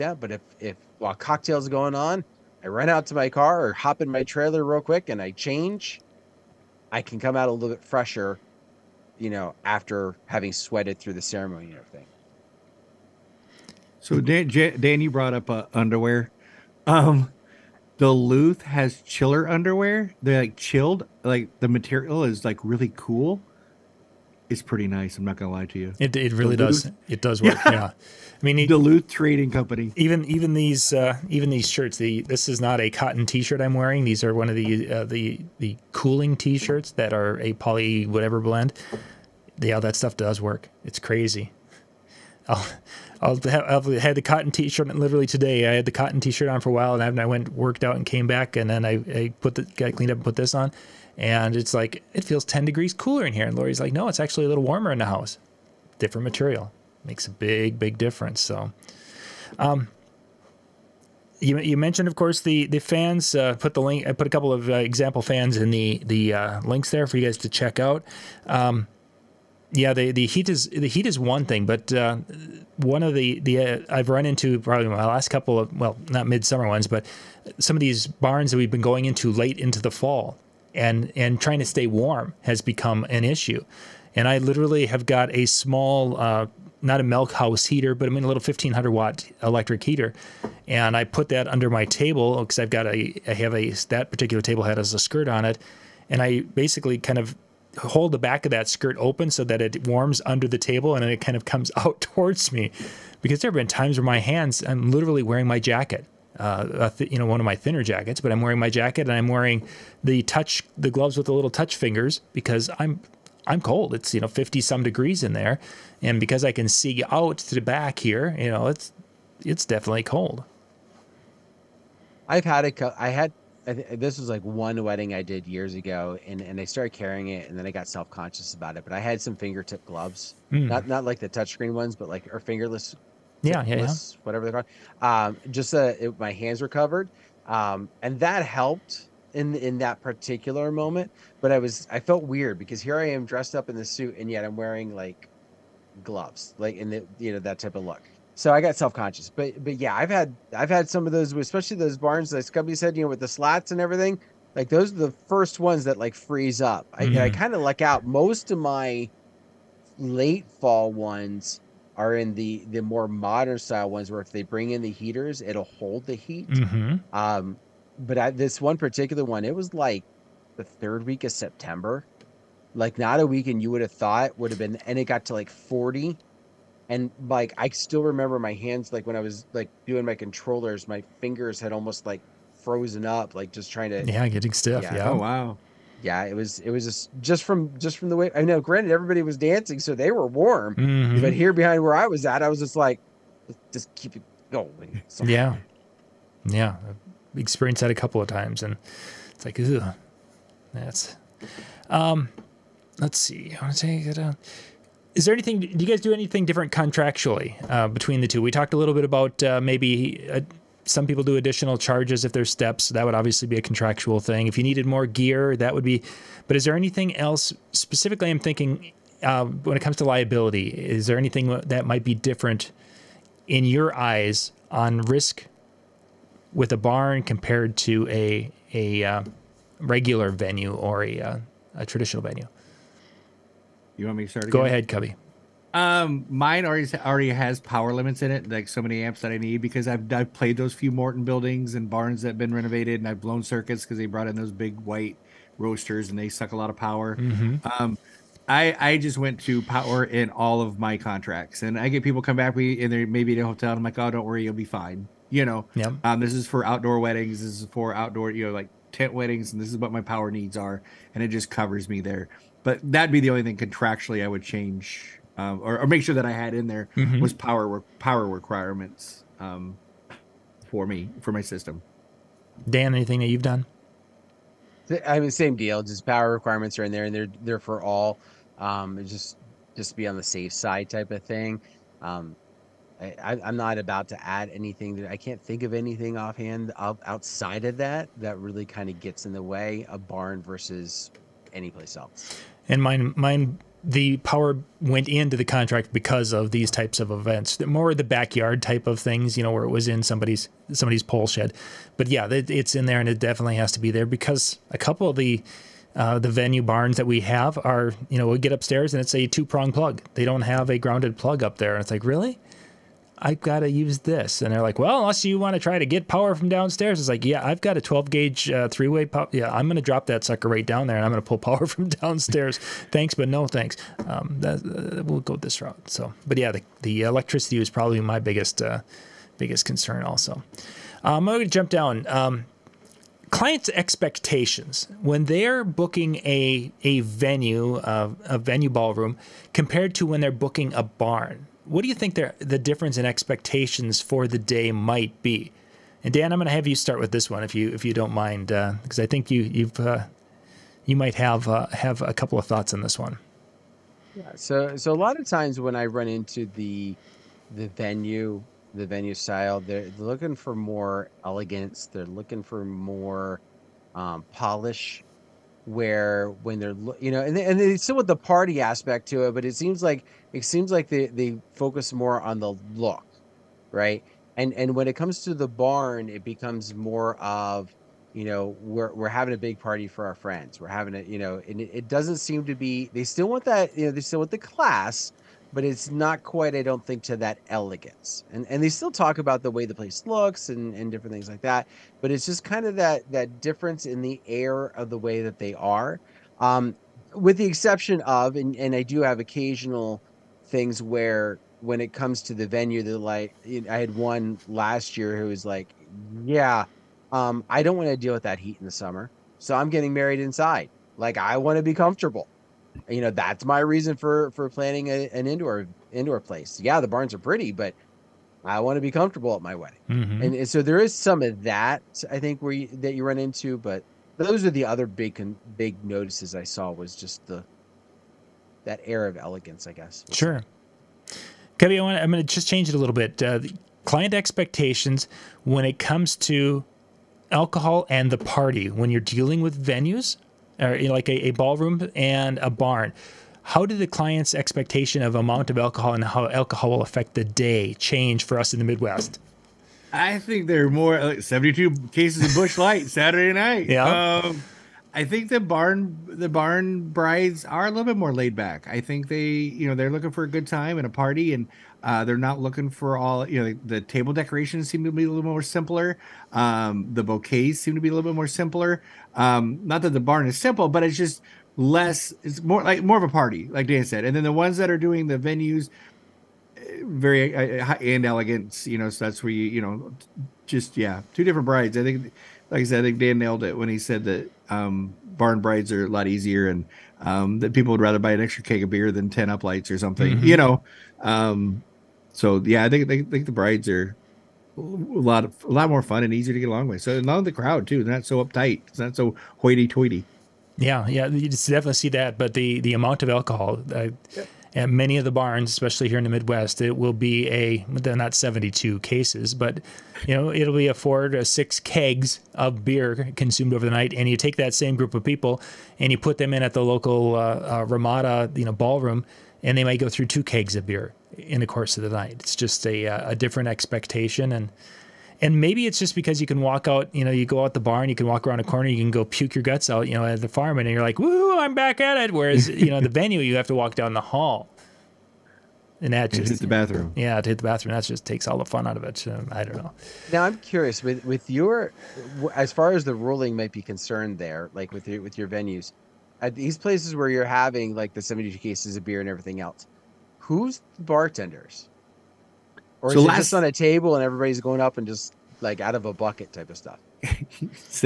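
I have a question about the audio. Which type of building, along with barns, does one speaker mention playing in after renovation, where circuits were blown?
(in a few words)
Morton buildings.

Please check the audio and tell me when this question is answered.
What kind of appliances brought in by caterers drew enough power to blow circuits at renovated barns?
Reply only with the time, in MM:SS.
04:04.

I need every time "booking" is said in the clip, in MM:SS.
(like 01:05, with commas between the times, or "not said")
05:35, 05:40.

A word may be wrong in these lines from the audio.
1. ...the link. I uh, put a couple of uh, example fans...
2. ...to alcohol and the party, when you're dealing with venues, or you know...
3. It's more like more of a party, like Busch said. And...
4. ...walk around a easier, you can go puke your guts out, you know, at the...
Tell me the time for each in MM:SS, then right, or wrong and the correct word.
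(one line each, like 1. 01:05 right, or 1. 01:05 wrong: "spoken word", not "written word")
1. 01:03 right
2. 07:16 right
3. 07:52 wrong: "Dan", not "Busch"
4. 08:48 wrong: "corner", not "easier".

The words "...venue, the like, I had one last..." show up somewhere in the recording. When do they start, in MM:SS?
06:42.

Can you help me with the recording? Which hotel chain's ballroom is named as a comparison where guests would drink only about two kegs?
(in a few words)
Ramada.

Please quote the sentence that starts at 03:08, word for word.
Granted, everybody was dancing, so they were warm.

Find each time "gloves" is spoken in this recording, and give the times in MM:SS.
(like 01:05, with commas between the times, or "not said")
01:50, 02:09, 02:26.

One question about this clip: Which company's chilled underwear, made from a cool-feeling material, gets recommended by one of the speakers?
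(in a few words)
Duluth Trading Company.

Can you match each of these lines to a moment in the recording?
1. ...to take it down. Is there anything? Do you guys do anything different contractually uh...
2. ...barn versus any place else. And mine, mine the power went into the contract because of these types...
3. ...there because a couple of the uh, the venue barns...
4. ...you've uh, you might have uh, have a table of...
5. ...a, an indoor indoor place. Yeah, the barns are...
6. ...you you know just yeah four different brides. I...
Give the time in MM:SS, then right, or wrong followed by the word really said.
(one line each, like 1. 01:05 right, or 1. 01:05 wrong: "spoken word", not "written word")
1. 03:23 right
2. 04:50 right
3. 05:03 right
4. 05:49 wrong: "couple", not "table"
5. 06:54 right
6. 07:59 wrong: "two", not "four".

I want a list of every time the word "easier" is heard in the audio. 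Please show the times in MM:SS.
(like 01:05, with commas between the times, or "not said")
08:06, 08:16.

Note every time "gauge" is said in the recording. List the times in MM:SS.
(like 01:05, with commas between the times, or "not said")
05:18.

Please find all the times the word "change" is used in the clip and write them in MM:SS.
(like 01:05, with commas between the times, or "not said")
00:05, 04:24, 07:12, 07:27.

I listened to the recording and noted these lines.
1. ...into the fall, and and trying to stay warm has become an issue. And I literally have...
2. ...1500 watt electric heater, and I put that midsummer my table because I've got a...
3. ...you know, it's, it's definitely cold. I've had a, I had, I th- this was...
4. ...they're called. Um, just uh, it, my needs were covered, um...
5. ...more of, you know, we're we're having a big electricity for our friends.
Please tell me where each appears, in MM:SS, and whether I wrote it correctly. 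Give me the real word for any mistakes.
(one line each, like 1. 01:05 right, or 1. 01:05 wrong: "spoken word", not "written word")
1. 01:19 right
2. 01:28 wrong: "under", not "midsummer"
3. 01:58 right
4. 02:14 wrong: "hands", not "needs"
5. 06:16 wrong: "party", not "electricity".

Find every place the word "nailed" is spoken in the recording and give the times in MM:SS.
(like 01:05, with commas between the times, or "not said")
08:03.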